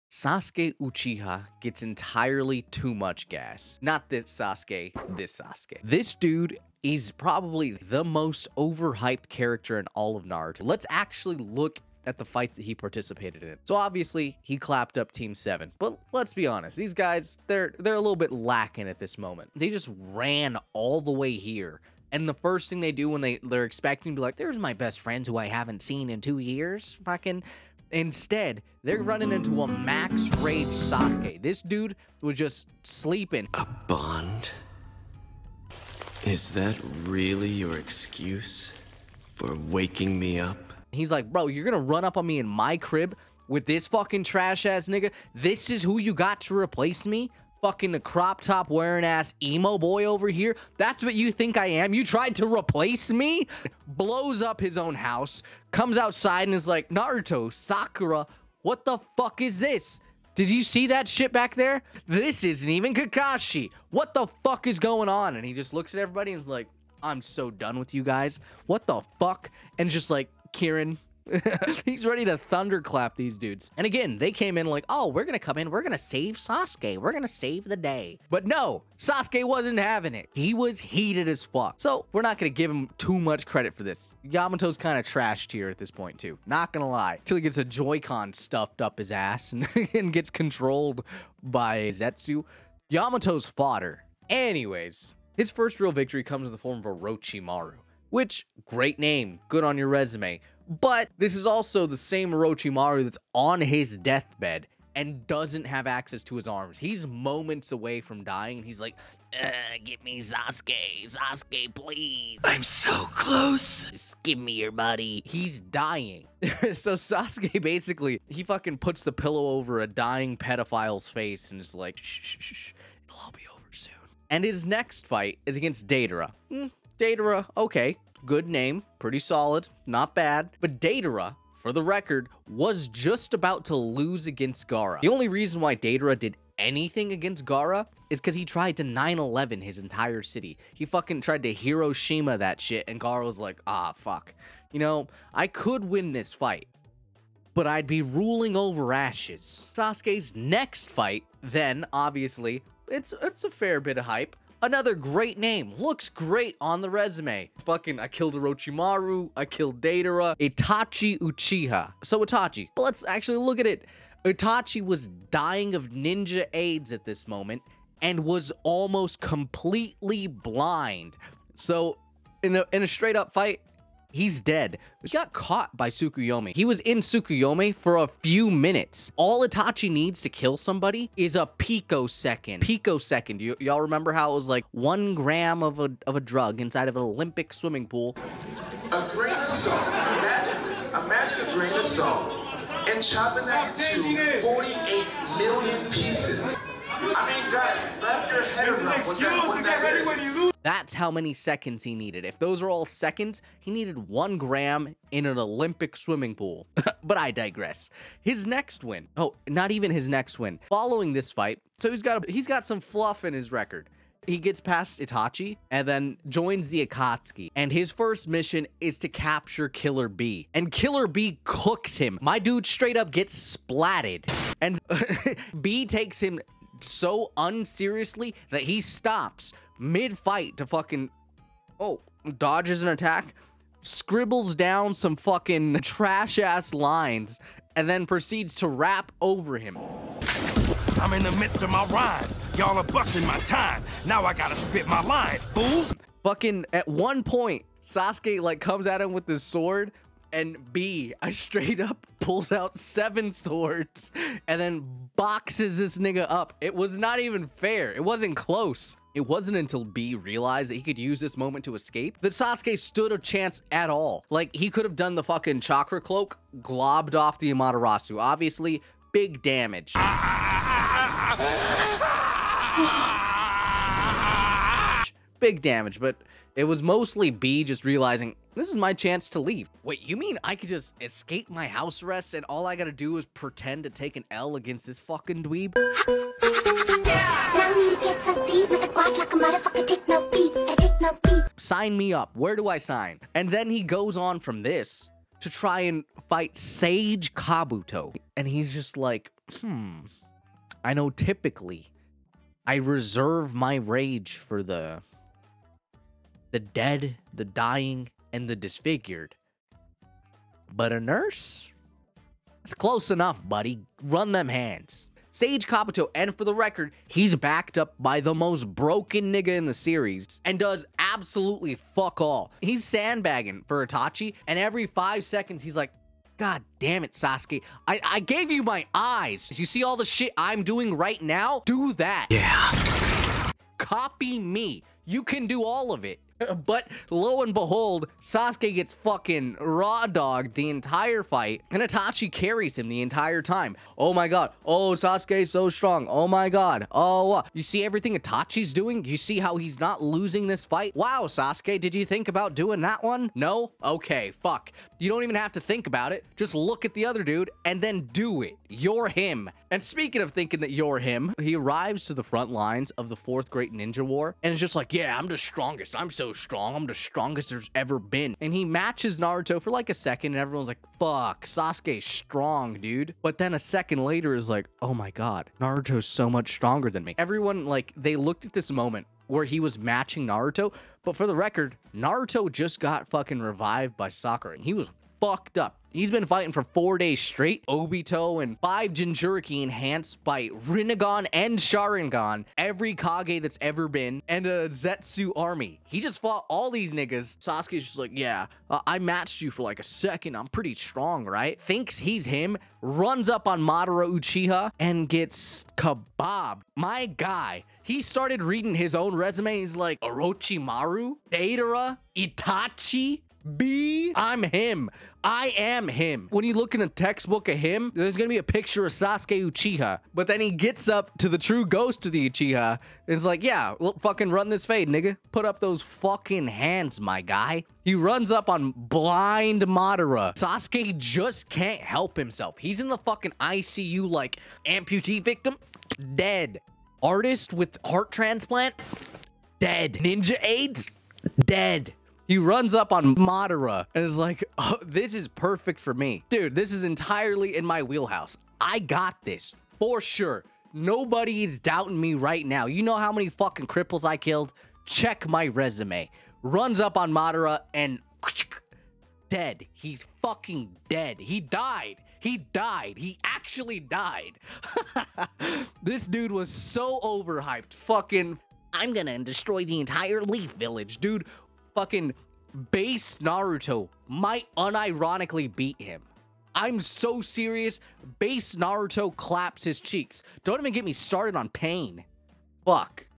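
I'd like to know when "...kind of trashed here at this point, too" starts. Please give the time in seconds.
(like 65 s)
84 s.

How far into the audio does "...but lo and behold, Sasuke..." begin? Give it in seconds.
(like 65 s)
336 s.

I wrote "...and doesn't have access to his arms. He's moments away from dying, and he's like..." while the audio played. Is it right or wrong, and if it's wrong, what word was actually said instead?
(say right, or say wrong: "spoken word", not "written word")
right.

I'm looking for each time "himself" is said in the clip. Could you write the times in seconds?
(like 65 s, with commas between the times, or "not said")
432 s.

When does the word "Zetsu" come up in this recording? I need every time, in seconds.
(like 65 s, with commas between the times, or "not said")
91 s, 394 s.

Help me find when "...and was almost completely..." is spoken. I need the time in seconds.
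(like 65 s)
168 s.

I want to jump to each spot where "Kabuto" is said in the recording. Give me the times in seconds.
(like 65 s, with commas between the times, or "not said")
297 s, 315 s.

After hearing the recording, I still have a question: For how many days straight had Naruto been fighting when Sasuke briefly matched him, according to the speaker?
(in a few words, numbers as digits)
4.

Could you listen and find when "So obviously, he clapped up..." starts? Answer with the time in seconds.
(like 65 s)
13 s.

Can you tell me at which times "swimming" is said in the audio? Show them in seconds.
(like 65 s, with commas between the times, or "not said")
187 s, 205 s.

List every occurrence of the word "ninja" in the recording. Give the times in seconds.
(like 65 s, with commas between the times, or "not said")
165 s, 363 s, 439 s.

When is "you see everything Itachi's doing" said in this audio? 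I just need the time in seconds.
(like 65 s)
347 s.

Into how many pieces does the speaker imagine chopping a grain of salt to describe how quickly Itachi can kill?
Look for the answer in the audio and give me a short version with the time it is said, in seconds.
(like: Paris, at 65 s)
48 million, at 194 s.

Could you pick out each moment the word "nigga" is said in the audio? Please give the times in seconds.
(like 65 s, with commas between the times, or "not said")
44 s, 255 s, 319 s, 396 s, 424 s.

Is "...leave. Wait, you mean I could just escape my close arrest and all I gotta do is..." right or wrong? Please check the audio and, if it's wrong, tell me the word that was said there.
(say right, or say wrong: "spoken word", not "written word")
wrong: "house", not "close".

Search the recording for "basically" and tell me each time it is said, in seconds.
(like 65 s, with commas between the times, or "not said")
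117 s.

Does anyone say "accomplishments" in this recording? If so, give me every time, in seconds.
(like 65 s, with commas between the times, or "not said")
not said.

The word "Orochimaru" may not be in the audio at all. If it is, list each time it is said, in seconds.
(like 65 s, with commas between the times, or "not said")
96 s, 102 s, 158 s, 409 s.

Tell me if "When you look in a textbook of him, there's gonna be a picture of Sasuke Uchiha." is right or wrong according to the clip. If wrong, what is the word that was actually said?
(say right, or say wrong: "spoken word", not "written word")
right.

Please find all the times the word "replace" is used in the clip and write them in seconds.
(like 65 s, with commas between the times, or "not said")
46 s, 52 s.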